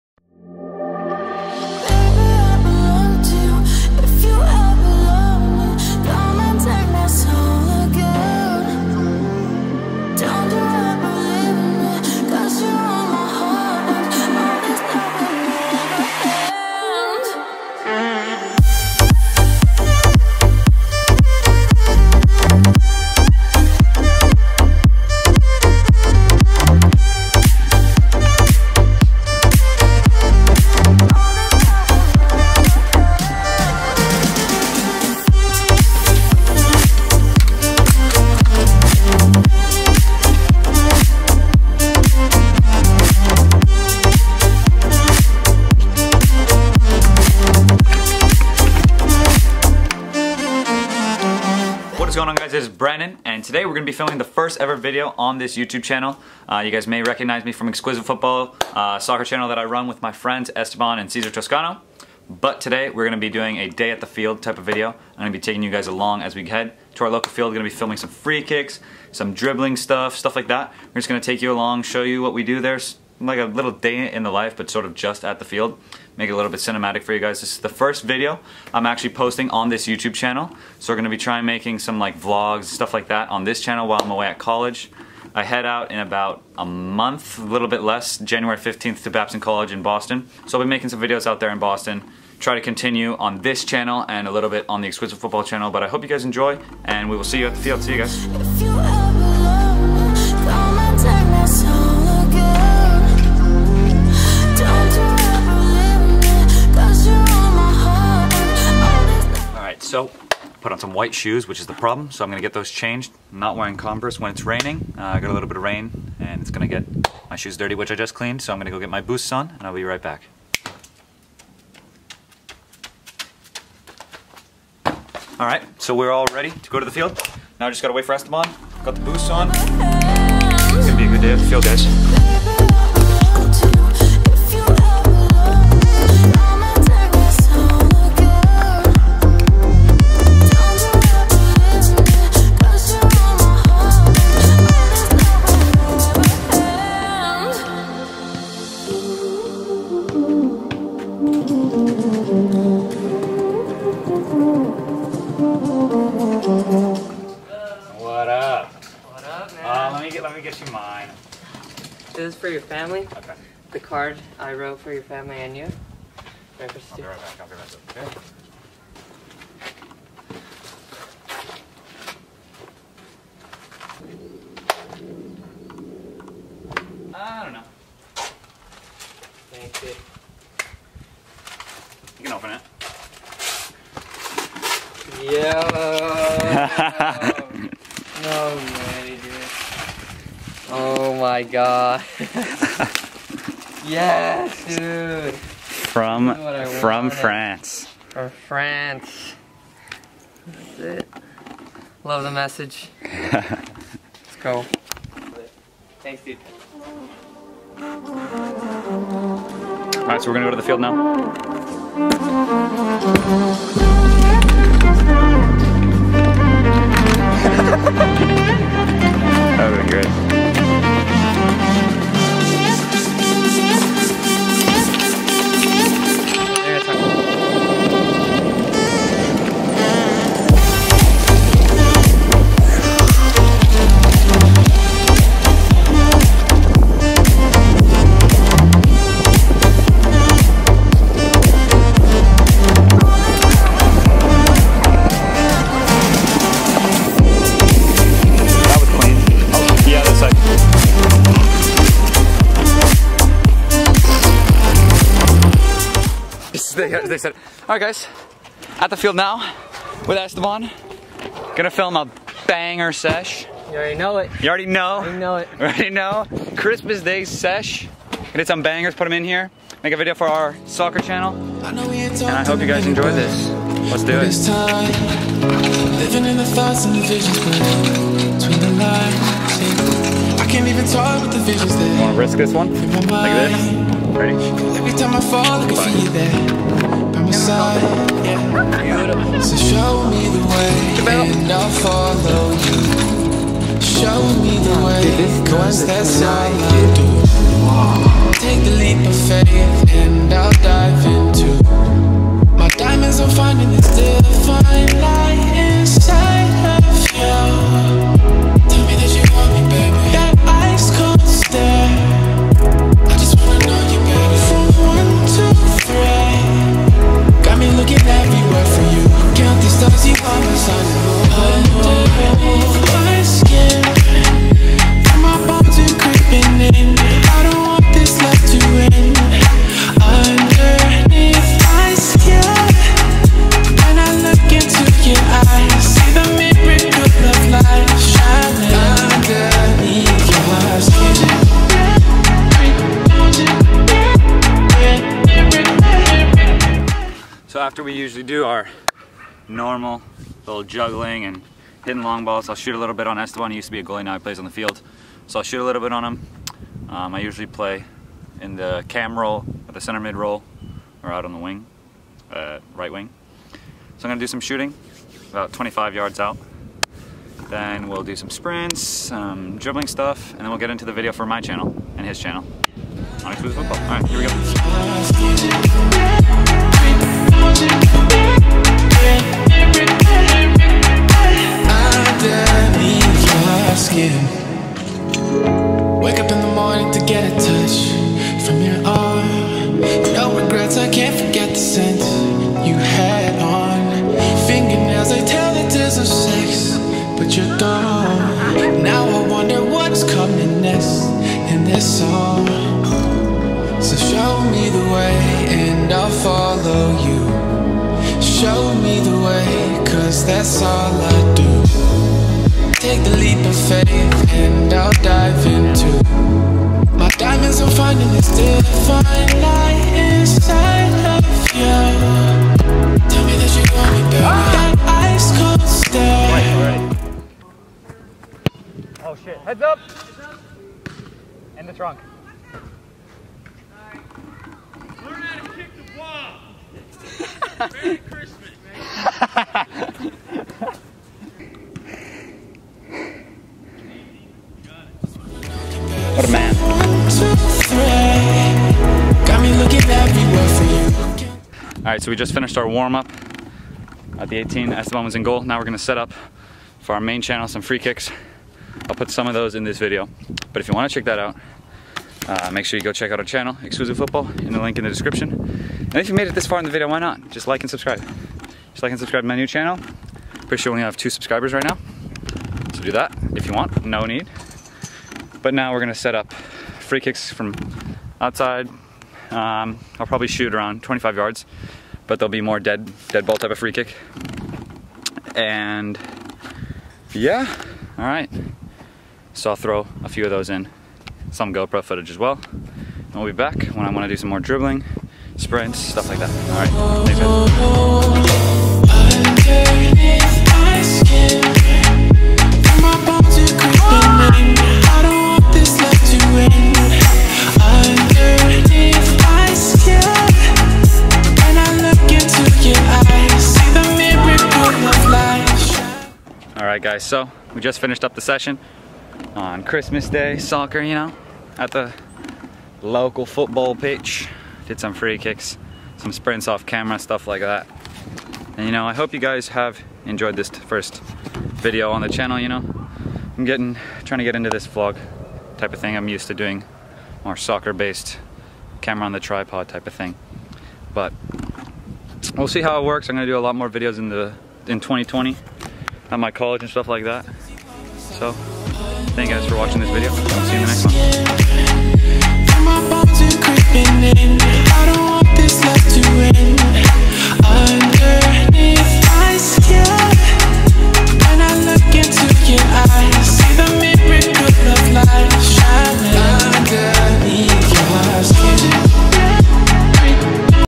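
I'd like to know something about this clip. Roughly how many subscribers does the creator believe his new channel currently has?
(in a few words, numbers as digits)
2.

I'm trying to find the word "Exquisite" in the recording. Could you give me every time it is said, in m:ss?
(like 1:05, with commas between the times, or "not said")
0:57, 1:34.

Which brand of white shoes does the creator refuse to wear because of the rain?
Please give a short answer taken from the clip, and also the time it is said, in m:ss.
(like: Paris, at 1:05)
Converse, at 1:53.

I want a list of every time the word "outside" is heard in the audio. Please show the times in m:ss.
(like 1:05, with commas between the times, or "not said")
7:58.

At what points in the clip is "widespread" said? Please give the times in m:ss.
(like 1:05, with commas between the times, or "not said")
not said.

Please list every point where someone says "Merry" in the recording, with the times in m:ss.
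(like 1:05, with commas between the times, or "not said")
7:17.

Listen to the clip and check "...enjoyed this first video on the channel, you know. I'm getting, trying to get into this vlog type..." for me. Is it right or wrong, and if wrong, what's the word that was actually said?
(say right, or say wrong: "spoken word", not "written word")
right.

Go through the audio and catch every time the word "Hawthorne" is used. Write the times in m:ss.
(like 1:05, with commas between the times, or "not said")
not said.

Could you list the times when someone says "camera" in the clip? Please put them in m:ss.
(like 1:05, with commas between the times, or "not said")
8:46, 8:58.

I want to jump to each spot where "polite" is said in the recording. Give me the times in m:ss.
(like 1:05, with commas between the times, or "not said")
not said.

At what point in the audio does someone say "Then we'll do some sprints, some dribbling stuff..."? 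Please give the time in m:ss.
6:07.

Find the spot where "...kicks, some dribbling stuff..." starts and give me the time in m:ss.
1:08.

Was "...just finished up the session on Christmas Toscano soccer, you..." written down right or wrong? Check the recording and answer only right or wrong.
wrong.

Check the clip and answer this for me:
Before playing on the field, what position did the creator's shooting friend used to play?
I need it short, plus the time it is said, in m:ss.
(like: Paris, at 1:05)
Goalie, at 5:53.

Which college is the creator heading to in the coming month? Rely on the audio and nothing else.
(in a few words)
Babson College.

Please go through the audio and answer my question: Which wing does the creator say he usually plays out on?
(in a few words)
Right wing.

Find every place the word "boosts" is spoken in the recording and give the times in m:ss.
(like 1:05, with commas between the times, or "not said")
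1:59.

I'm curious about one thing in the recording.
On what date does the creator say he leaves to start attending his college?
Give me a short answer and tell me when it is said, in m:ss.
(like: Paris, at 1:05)
January 15th, at 1:28.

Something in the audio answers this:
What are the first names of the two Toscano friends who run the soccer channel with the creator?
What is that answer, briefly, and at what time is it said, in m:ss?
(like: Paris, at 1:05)
Esteban and Cesar, at 1:00.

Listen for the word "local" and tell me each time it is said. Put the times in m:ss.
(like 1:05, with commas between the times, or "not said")
1:07, 8:42.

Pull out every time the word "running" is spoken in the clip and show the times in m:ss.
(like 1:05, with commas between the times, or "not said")
not said.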